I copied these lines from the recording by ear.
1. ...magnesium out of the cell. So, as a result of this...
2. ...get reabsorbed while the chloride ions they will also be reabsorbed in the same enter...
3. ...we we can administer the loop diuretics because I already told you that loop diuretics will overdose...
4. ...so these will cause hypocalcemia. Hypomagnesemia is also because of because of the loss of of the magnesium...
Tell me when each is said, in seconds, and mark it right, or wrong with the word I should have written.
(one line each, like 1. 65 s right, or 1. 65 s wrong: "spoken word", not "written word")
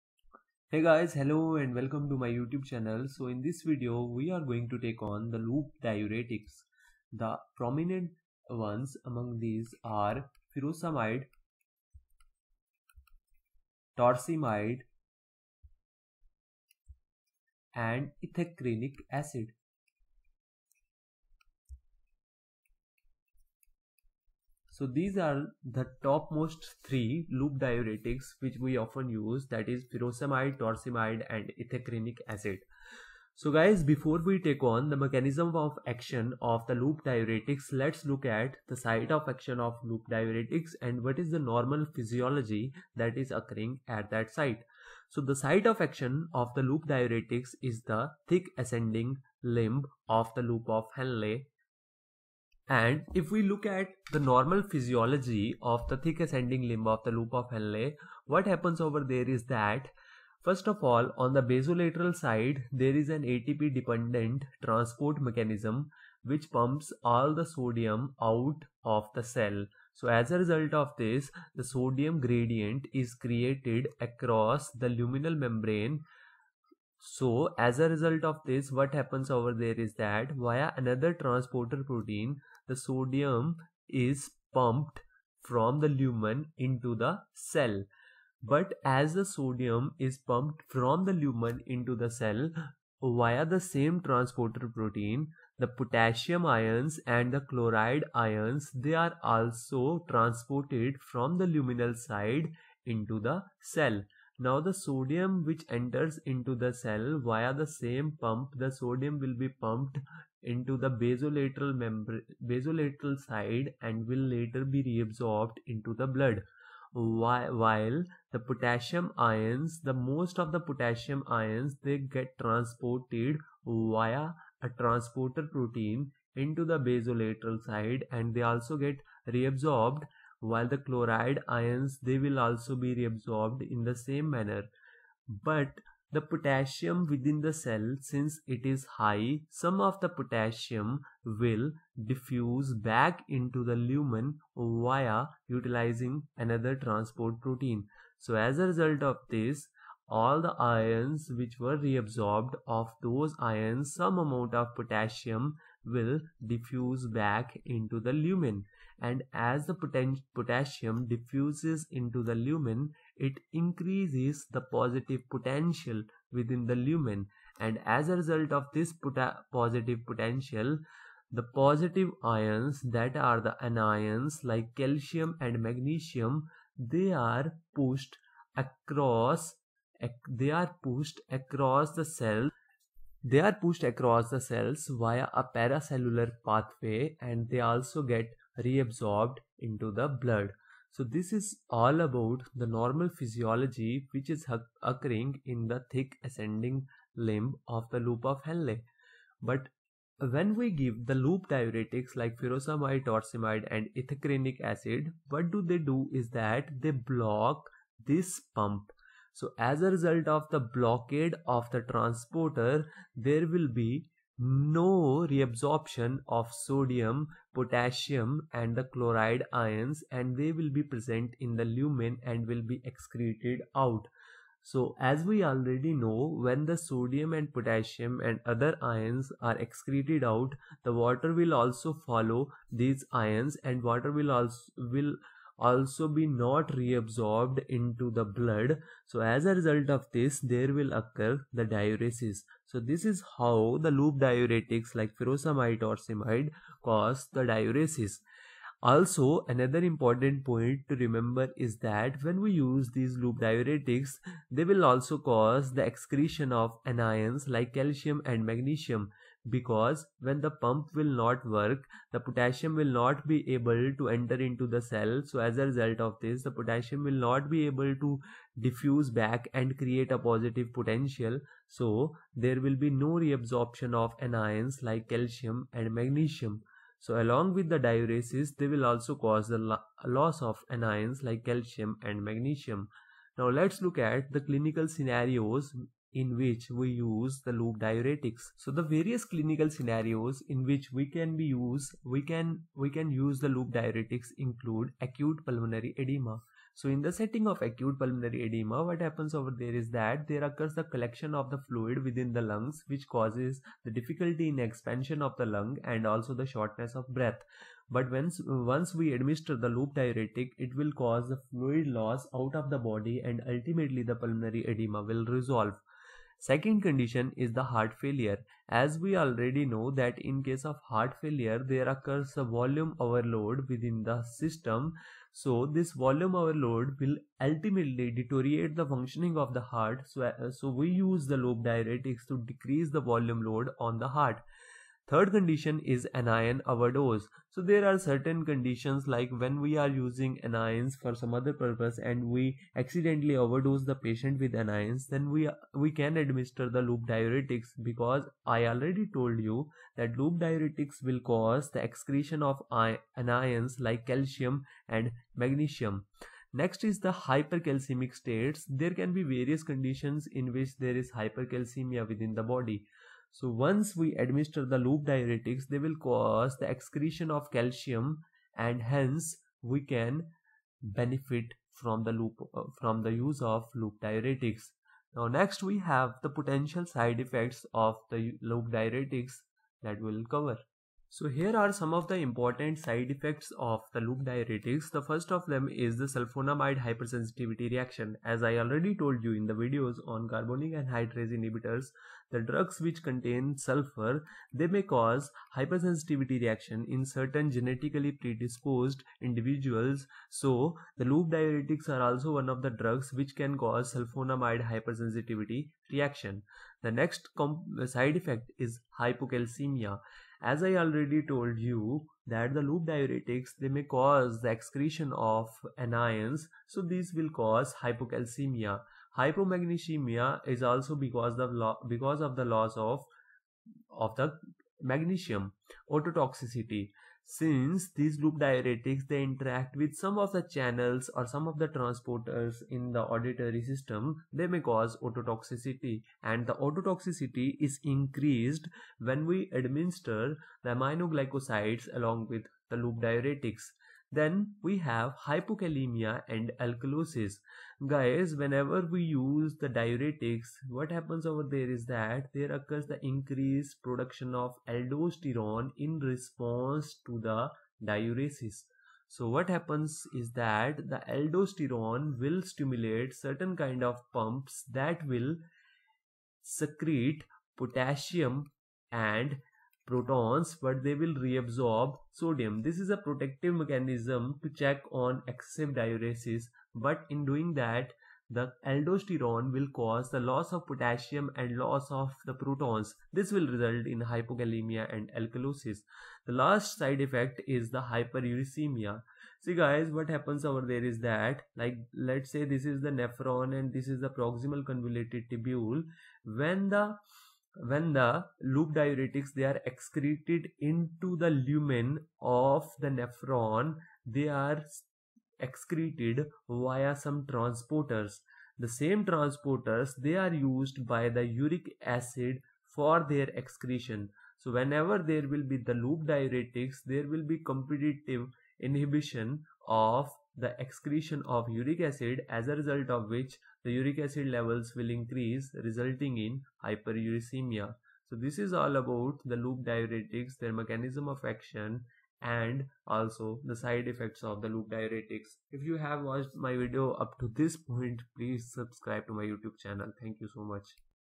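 1. 67 s wrong: "sodium", not "magnesium"
2. 128 s wrong: "manner", not "enter"
3. 345 s wrong: "cause", not "overdose"
4. 416 s right.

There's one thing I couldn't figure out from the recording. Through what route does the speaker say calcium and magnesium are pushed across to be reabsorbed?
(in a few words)
Paracellular pathway.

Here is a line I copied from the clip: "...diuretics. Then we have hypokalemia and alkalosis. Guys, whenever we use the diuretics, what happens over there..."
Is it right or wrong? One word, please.
right.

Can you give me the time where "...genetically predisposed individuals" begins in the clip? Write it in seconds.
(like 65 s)
397 s.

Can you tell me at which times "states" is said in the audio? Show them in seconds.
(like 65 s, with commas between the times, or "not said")
358 s.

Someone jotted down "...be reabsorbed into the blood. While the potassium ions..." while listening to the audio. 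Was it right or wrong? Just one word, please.
right.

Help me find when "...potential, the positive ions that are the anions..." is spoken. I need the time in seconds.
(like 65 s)
170 s.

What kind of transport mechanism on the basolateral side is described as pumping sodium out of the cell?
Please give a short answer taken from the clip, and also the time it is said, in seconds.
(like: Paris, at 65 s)
ATP dependent, at 63 s.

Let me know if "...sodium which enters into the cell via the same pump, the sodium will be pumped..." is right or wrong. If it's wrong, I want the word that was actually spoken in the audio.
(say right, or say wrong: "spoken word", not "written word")
right.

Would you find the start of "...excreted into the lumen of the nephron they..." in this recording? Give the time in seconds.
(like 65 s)
499 s.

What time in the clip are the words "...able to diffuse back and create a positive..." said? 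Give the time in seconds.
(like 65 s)
267 s.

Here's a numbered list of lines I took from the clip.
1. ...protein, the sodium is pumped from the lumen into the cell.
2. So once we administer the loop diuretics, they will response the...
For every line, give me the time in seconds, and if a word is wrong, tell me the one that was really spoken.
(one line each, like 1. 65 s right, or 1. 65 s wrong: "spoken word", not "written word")
1. 81 s right
2. 363 s wrong: "cause", not "response".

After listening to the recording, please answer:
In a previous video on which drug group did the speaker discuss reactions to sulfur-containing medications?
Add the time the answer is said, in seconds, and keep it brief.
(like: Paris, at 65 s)
Carbonic anhydrase inhibitors, at 390 s.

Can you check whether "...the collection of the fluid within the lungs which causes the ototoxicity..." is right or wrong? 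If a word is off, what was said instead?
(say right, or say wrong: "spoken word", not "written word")
wrong: "difficulty", not "ototoxicity".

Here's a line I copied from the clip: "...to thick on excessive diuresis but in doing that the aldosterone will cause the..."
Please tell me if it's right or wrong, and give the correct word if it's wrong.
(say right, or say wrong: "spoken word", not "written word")
wrong: "check", not "thick".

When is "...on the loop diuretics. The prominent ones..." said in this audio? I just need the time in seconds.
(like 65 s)
5 s.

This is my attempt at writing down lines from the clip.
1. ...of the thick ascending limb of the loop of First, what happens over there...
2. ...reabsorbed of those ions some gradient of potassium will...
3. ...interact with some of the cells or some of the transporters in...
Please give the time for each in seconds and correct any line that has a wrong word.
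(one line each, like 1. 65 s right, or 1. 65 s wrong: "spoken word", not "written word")
1. 55 s wrong: "Henle", not "First"
2. 151 s wrong: "amount", not "gradient"
3. 429 s wrong: "channels", not "cells".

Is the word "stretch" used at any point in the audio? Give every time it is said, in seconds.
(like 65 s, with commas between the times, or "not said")
not said.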